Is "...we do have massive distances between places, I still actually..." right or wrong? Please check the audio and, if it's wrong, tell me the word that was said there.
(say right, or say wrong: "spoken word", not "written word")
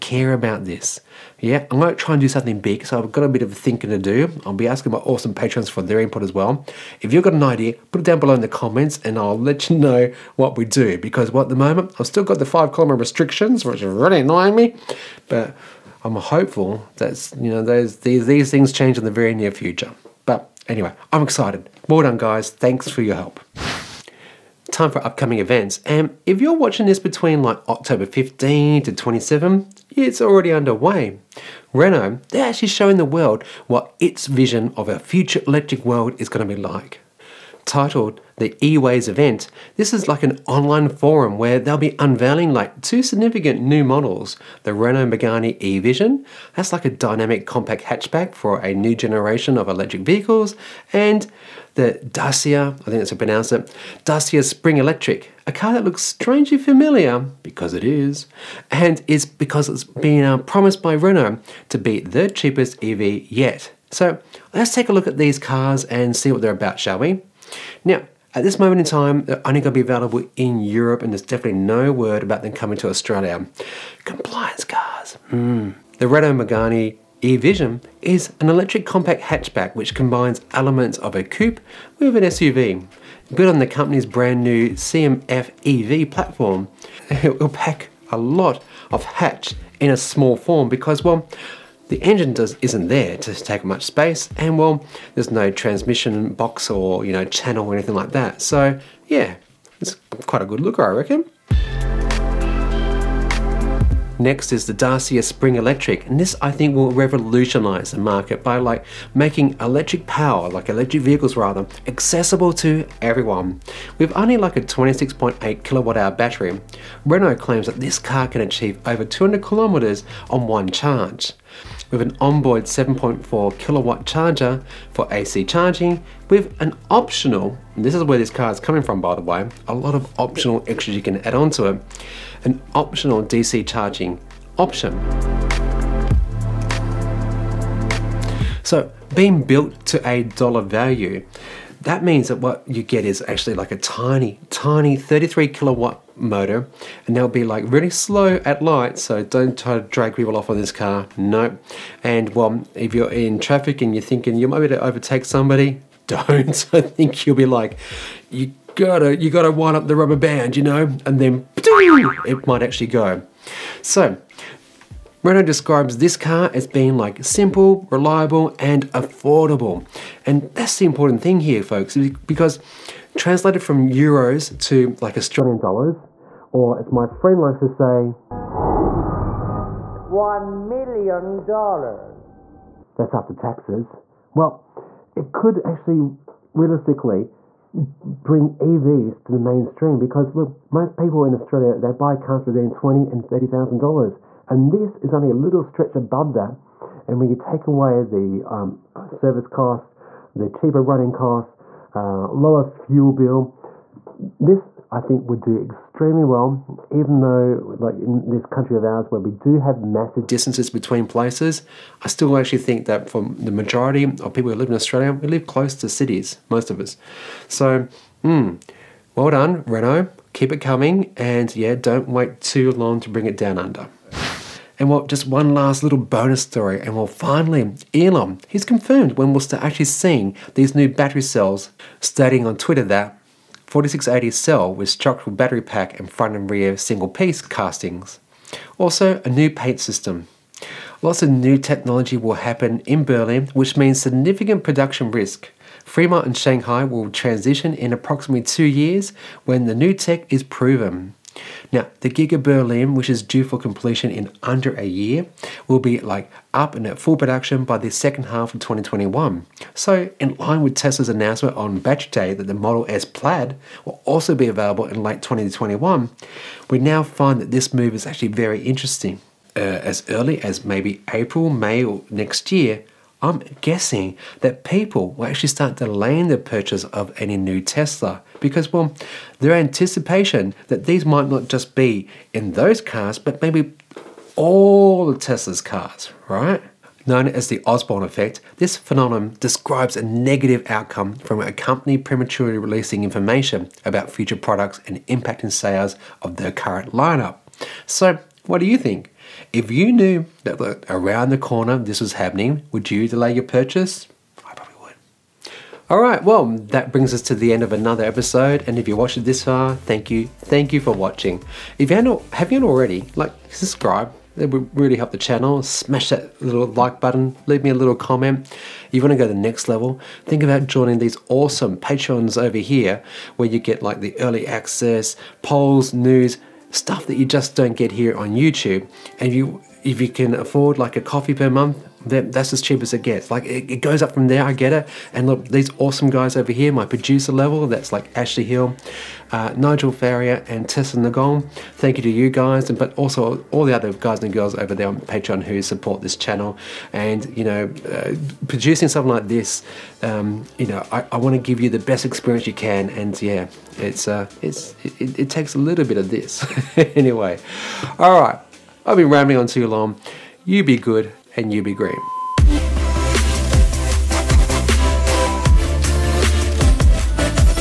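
right.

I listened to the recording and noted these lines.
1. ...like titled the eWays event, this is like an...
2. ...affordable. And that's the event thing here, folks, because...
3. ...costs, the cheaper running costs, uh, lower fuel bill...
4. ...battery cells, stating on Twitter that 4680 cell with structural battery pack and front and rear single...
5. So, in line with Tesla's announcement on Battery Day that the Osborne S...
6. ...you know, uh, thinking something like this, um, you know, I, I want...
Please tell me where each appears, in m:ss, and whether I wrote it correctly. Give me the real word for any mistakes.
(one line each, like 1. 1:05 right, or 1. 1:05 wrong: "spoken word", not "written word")
1. 0:36 right
2. 2:48 wrong: "important", not "event"
3. 3:19 right
4. 3:50 right
5. 4:19 wrong: "Model", not "Osborne"
6. 5:47 wrong: "producing", not "thinking".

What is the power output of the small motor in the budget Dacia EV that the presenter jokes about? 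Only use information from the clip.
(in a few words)
33 kilowatts.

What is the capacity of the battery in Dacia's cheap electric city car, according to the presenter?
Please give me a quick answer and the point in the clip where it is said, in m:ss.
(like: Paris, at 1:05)
26.8 kilowatt hours, at 1:54.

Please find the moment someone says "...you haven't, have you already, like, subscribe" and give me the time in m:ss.
5:11.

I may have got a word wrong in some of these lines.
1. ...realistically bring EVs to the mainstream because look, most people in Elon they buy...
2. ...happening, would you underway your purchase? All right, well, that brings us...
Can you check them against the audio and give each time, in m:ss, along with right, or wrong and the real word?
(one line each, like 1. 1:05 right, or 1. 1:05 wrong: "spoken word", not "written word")
1. 3:06 wrong: "Australia", not "Elon"
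2. 5:02 wrong: "delay", not "underway".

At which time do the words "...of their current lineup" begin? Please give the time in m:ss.
4:56.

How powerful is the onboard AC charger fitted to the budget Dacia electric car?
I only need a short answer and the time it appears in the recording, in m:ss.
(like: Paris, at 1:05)
7.4 kilowatts, at 2:02.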